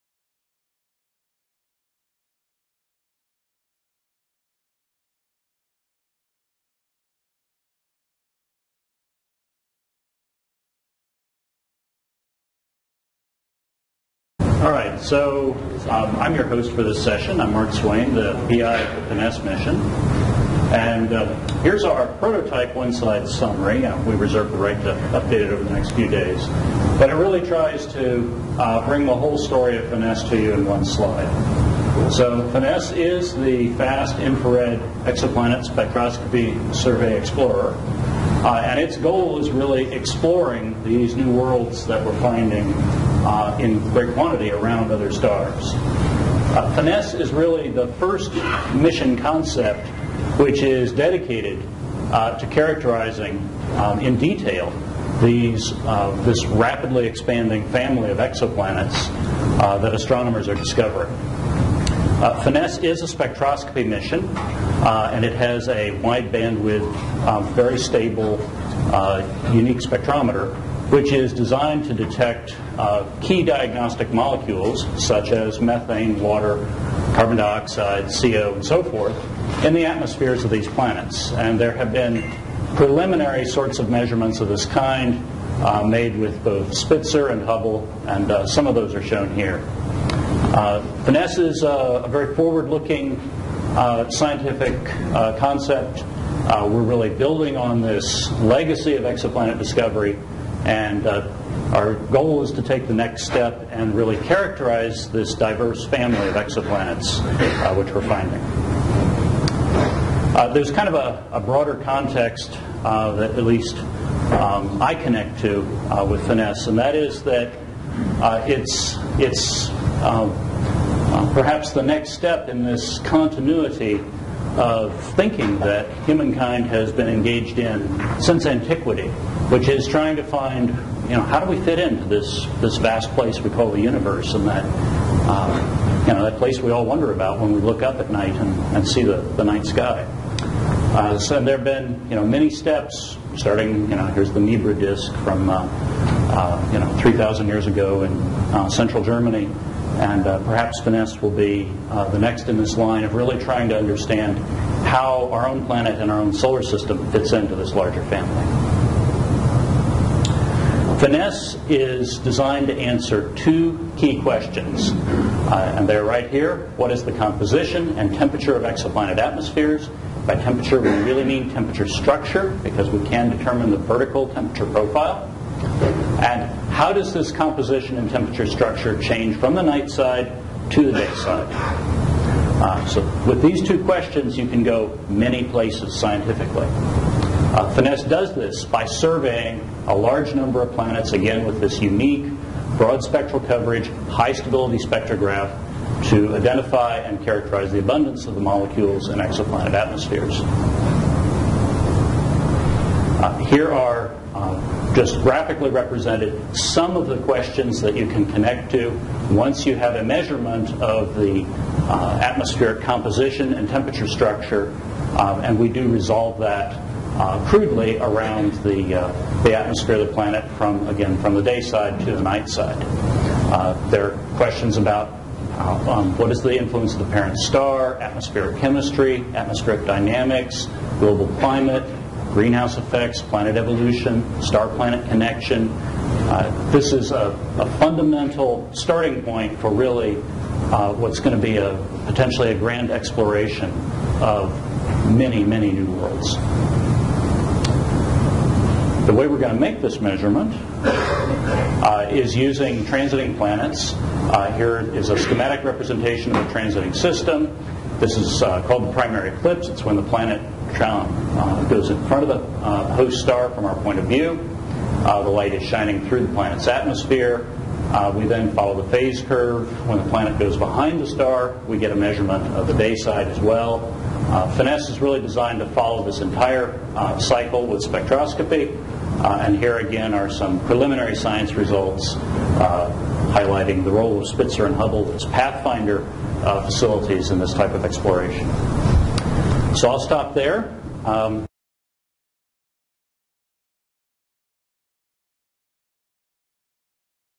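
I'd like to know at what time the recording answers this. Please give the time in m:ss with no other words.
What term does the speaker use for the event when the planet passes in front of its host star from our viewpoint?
4:18.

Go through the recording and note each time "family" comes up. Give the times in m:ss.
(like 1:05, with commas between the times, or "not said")
0:57, 1:45, 2:38.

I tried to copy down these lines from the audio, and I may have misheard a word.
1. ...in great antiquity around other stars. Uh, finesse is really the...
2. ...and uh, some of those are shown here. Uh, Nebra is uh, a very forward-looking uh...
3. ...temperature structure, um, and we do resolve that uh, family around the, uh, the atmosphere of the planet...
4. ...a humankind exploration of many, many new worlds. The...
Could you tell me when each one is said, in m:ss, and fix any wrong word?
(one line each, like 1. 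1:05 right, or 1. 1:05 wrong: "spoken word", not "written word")
1. 0:43 wrong: "quantity", not "antiquity"
2. 1:28 wrong: "Finesse", not "Nebra"
3. 3:33 wrong: "crudely", not "family"
4. 4:02 wrong: "grand", not "humankind".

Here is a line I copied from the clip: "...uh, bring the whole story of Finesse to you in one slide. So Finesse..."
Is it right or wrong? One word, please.
right.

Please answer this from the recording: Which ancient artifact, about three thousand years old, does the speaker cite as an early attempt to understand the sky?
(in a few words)
Nebra disk.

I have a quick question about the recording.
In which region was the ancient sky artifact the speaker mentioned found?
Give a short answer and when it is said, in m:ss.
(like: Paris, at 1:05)
Central Germany, at 2:28.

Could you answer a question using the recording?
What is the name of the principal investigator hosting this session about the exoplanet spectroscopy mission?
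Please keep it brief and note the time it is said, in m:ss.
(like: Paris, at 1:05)
Mark Swain, at 0:17.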